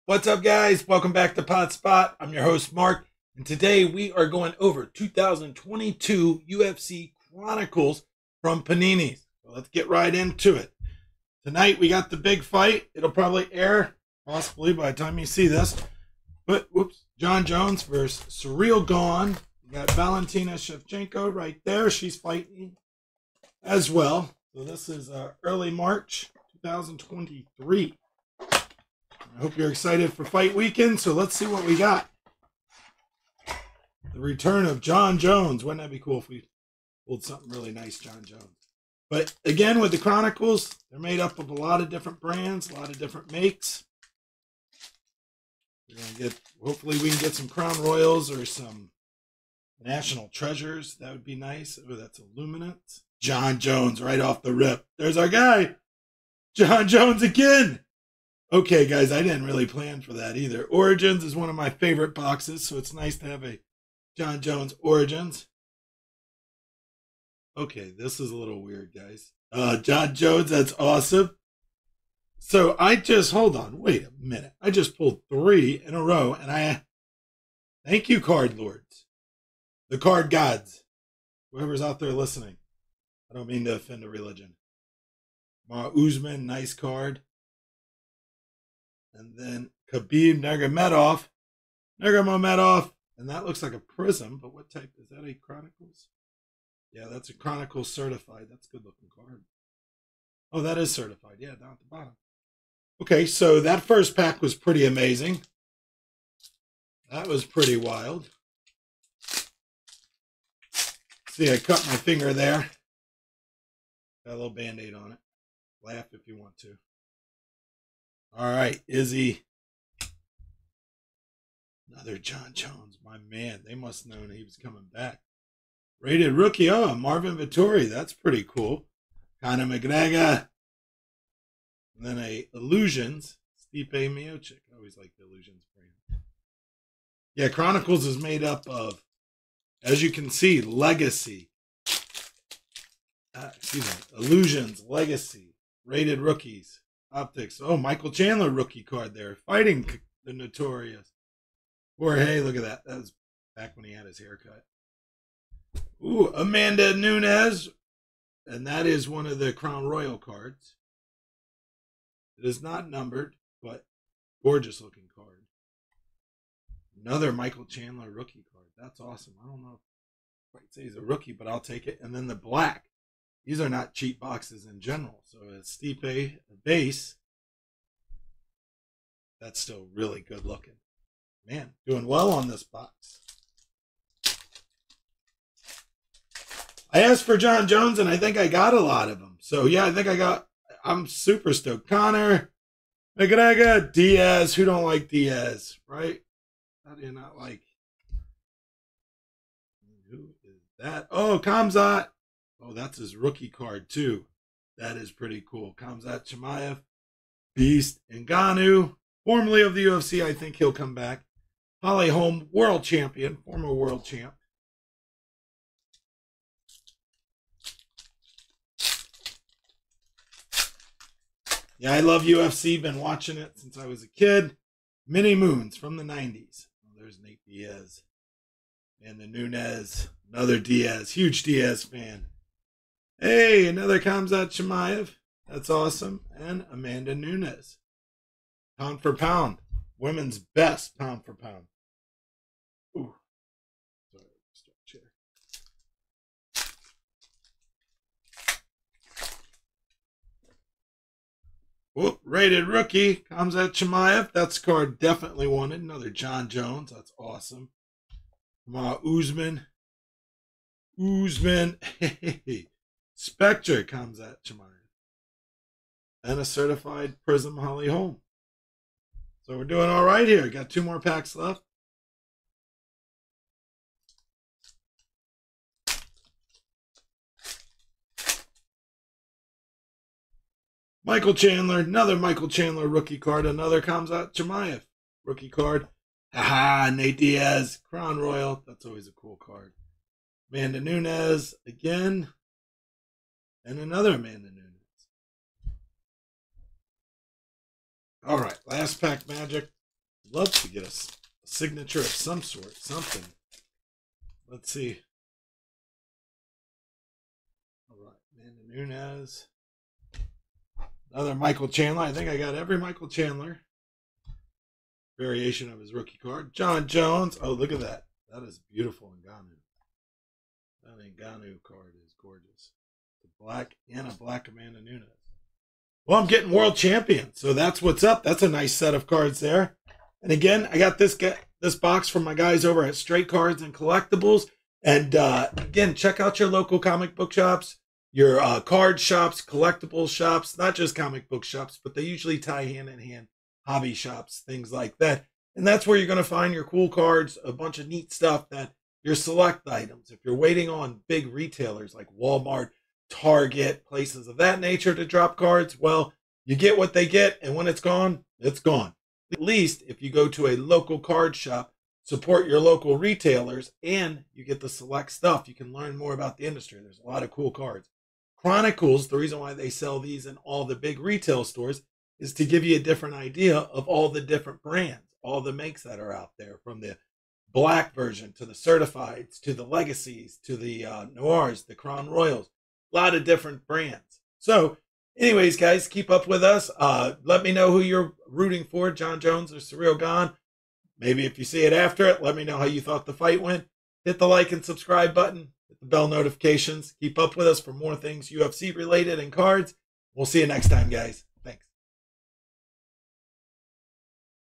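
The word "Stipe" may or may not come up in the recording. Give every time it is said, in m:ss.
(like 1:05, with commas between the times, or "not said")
2:13, 2:55.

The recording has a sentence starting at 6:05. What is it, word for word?
You can learn more about the industry.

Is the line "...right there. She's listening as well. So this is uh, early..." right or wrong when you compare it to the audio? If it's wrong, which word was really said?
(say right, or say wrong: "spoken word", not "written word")
wrong: "fighting", not "listening".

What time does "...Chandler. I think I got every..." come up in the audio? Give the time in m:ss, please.
5:11.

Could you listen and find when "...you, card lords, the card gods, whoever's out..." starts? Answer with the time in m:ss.
1:18.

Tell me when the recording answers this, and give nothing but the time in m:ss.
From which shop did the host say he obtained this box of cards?
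5:32.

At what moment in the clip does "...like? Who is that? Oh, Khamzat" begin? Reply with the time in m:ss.
3:17.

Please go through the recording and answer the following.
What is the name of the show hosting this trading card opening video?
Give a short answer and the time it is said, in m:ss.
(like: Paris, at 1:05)
Potts Spot, at 0:01.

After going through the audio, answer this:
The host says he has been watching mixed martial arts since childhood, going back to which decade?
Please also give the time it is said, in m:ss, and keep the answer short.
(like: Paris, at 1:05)
the 90s, at 3:45.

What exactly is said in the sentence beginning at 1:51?
See, I cut my finger there.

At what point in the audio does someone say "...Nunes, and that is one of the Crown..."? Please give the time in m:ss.
2:36.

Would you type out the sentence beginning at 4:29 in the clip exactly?
So we're doing all right here.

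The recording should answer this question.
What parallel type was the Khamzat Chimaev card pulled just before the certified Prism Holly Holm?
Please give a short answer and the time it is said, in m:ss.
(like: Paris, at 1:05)
Spectre, at 4:23.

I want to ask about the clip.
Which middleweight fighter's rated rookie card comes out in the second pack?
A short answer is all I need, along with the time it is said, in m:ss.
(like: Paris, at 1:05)
Marvin Vettori, at 2:06.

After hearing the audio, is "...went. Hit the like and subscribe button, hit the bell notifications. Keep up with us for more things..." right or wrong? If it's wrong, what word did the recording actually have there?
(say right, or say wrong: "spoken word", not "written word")
right.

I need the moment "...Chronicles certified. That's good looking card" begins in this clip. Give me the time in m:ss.
1:37.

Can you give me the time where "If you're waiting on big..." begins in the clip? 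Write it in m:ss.
5:50.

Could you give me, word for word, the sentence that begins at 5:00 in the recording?
Love to get a, a signature of some sort, something.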